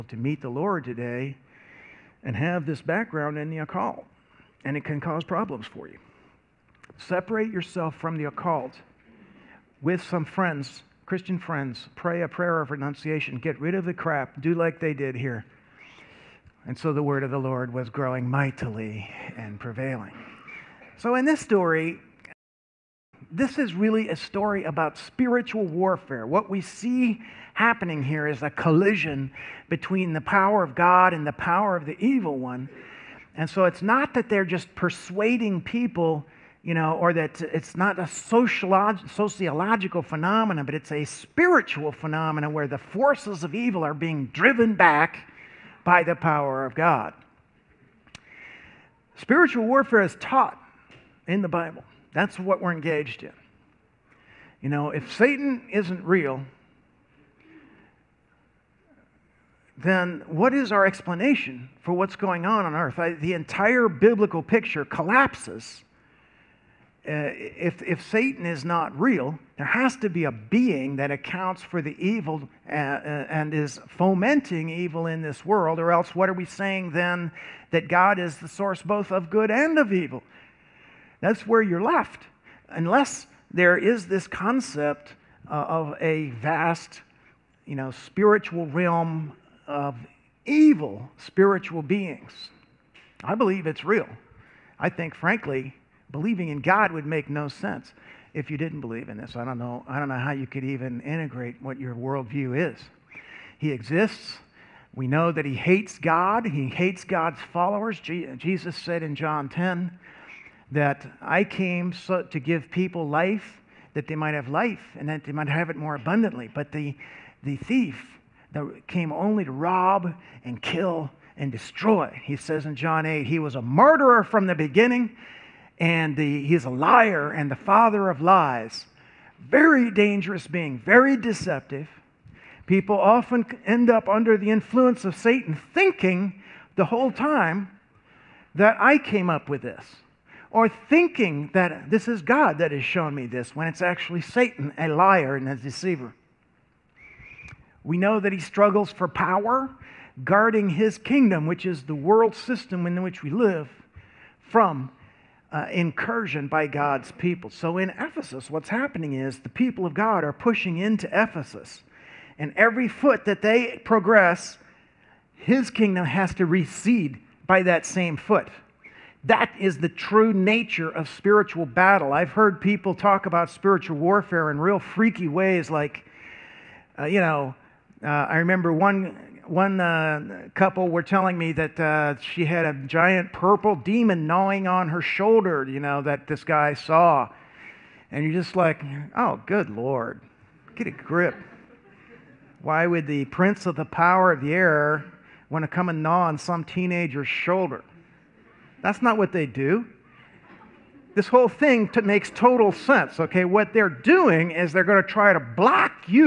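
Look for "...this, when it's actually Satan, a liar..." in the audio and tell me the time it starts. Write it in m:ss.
2:23.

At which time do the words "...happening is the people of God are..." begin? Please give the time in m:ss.
2:38.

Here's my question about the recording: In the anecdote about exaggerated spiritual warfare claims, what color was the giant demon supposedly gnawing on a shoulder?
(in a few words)
purple.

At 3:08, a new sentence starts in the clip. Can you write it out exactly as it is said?
And you're just like, oh, good Lord, get a grip.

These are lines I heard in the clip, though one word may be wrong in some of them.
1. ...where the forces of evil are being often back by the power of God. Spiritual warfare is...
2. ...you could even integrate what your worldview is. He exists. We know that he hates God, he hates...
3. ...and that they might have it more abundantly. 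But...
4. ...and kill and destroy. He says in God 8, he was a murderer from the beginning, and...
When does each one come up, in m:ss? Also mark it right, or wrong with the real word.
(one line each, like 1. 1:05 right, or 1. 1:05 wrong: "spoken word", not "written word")
1. 0:42 wrong: "driven", not "often"
2. 1:40 right
3. 1:54 right
4. 2:00 wrong: "John", not "God".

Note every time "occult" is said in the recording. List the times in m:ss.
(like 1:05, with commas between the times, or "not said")
0:03, 0:08.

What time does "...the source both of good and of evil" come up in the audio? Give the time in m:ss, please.
1:18.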